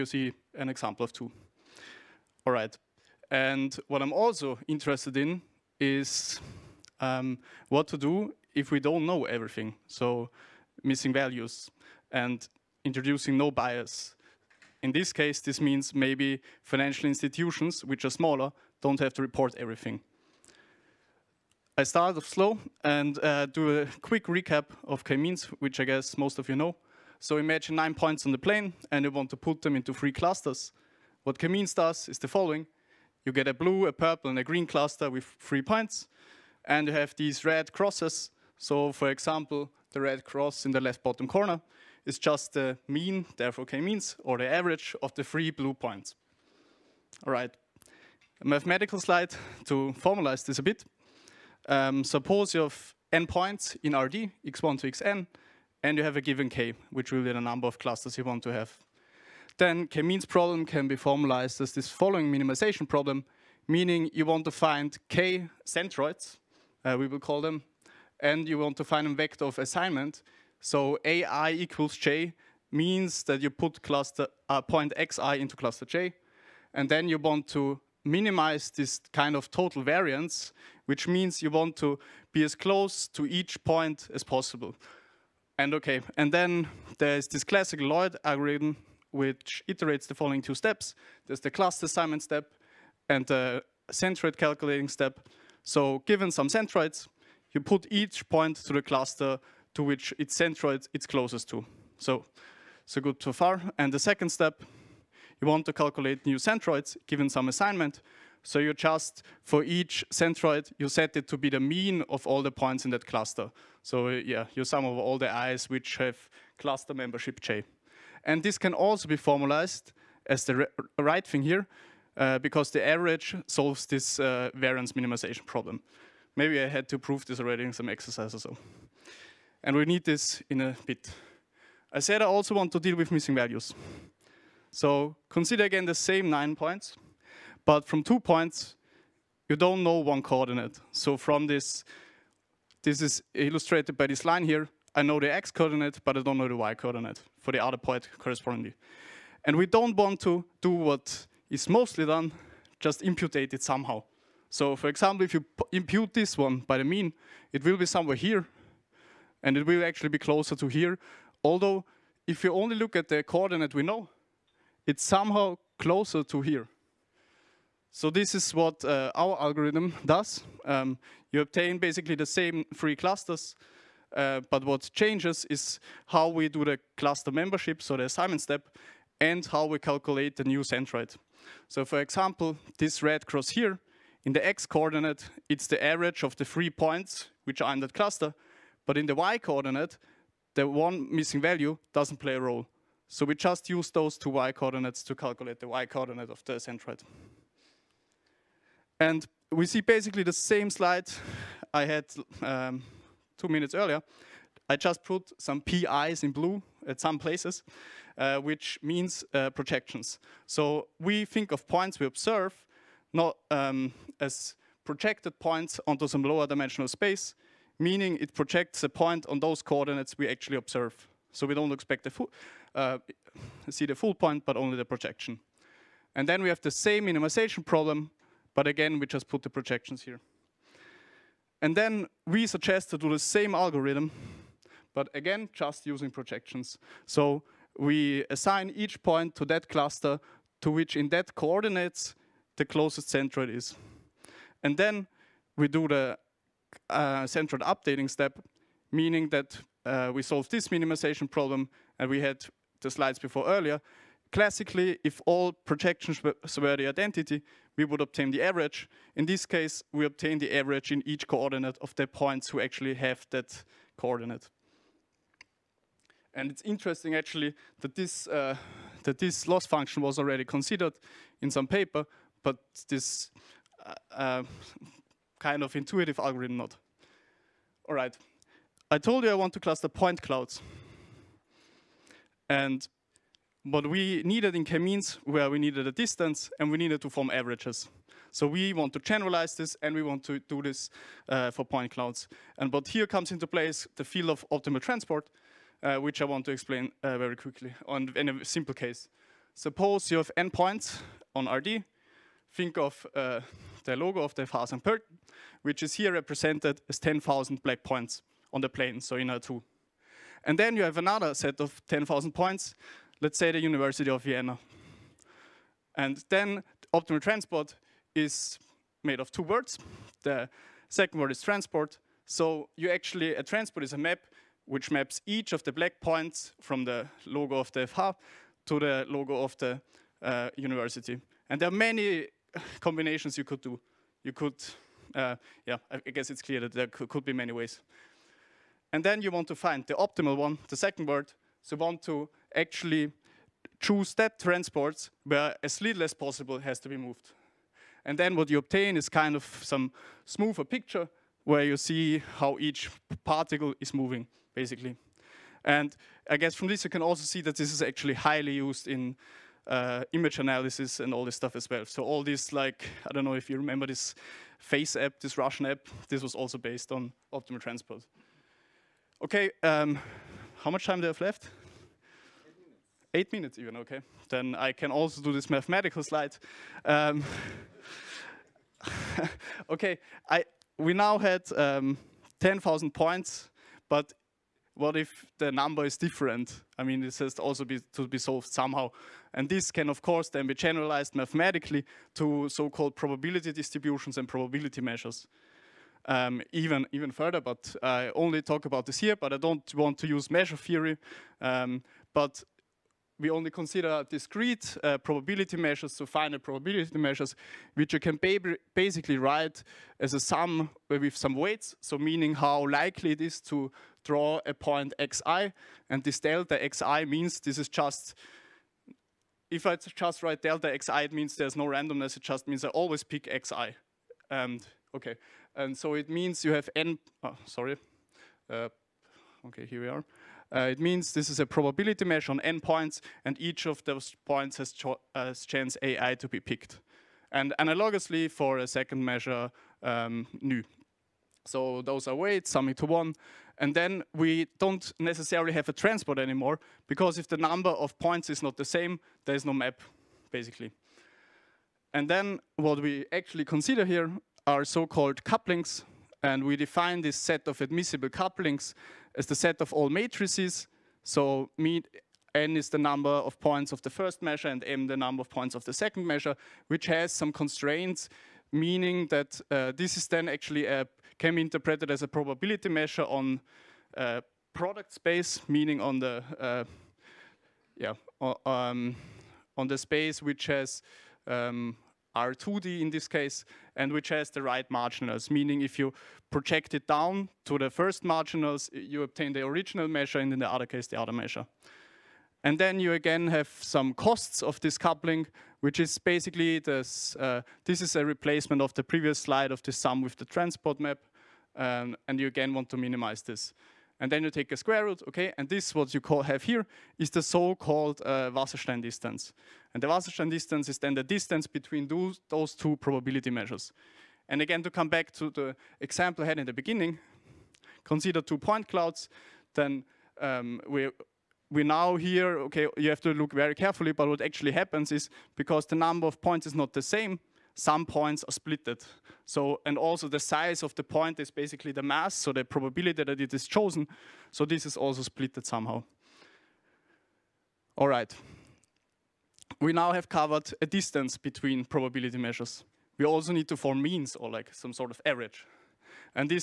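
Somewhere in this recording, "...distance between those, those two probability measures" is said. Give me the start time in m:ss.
8:31.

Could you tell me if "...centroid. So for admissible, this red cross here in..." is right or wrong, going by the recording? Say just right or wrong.
wrong.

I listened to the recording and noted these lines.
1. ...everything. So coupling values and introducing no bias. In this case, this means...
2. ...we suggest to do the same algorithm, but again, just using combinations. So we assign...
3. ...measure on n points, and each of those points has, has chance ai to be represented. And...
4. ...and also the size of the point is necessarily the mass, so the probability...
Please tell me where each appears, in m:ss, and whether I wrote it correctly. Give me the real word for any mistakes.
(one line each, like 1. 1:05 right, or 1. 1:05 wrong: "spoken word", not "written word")
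1. 0:09 wrong: "missing", not "coupling"
2. 3:52 wrong: "projections", not "combinations"
3. 7:12 wrong: "picked", not "represented"
4. 8:49 wrong: "basically", not "necessarily".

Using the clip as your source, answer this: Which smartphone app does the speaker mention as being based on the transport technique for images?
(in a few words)
FaceApp.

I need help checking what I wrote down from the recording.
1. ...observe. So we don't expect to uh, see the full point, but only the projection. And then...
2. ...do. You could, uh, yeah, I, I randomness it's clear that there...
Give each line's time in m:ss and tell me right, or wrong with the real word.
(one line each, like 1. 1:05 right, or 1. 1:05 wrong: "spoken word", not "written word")
1. 3:40 right
2. 5:33 wrong: "guess", not "randomness".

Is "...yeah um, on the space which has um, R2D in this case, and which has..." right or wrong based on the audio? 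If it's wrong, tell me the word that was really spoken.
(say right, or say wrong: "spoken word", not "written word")
right.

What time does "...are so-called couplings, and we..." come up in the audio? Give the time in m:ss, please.
7:34.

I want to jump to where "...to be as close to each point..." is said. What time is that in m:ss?
1:21.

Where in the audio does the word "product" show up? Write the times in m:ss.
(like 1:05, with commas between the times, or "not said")
7:54.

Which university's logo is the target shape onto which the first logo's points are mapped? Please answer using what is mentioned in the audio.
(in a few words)
University of Vienna.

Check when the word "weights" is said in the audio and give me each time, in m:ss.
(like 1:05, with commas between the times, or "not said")
6:51, 7:22.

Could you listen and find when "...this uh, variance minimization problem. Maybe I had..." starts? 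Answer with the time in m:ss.
2:03.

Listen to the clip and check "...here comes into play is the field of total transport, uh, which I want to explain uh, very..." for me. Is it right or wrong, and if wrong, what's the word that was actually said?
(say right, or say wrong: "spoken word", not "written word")
wrong: "optimal", not "total".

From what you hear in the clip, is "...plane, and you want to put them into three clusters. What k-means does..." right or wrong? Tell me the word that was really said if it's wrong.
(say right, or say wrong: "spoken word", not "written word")
right.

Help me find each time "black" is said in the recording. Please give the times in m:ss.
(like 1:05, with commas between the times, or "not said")
5:07, 5:25.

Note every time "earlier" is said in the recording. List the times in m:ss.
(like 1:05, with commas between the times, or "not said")
3:23, 4:13.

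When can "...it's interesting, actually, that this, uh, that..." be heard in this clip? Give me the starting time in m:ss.
4:26.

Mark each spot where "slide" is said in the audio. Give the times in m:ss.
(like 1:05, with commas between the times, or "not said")
0:49, 3:20, 4:12, 6:16, 8:19.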